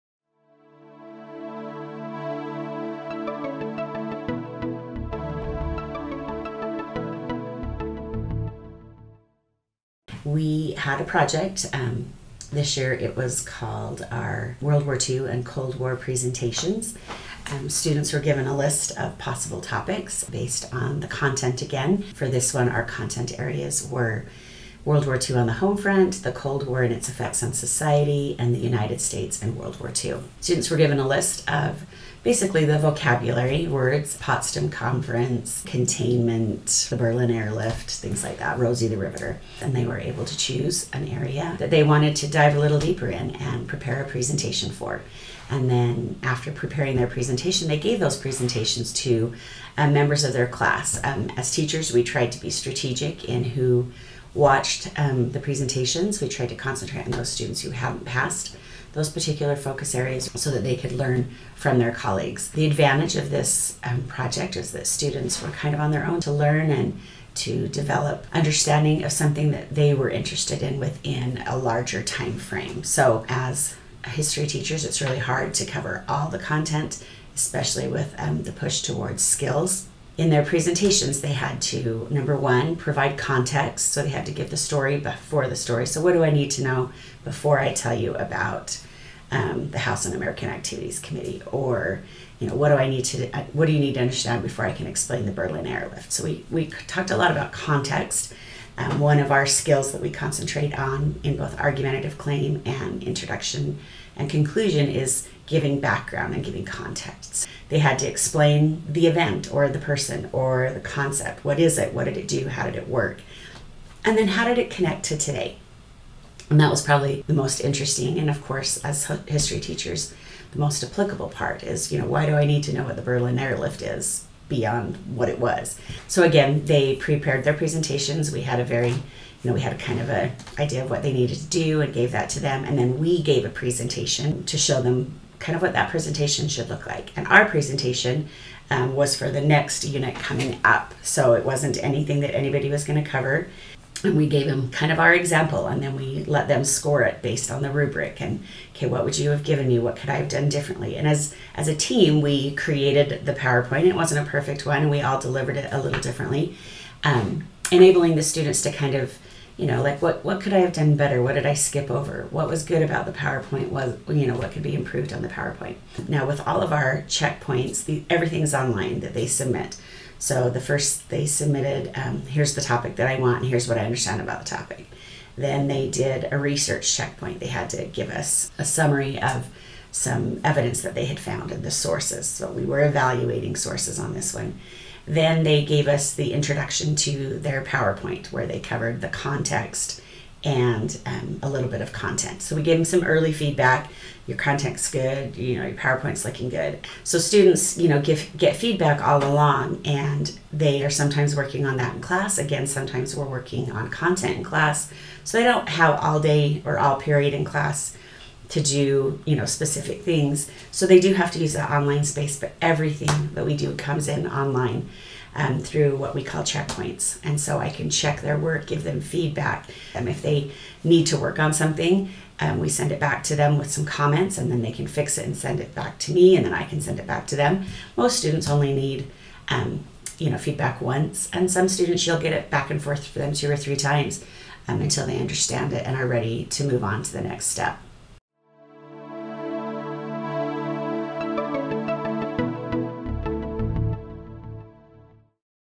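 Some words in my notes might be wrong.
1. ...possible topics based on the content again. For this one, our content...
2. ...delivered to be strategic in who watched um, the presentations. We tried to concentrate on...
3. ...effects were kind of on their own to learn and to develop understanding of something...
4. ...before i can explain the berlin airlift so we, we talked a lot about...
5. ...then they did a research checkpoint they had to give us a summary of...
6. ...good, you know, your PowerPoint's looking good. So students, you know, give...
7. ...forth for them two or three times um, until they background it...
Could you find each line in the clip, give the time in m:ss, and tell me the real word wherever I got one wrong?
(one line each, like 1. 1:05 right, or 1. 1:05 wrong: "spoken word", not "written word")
1. 0:19 right
2. 0:52 wrong: "tried", not "delivered"
3. 1:04 wrong: "students", not "effects"
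4. 1:34 right
5. 2:55 right
6. 3:14 right
7. 3:52 wrong: "understand", not "background".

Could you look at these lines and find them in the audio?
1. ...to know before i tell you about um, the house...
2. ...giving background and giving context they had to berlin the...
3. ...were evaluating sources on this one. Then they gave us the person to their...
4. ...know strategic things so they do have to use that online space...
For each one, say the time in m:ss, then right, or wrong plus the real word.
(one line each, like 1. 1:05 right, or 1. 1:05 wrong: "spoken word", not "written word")
1. 1:26 right
2. 1:45 wrong: "explain", not "berlin"
3. 3:02 wrong: "introduction", not "person"
4. 3:29 wrong: "specific", not "strategic".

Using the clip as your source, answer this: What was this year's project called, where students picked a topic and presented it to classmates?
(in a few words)
World War II and Cold War presentations.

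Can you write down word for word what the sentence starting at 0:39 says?
And they were able to choose an area that they wanted to dive a little deeper in and prepare a presentation for.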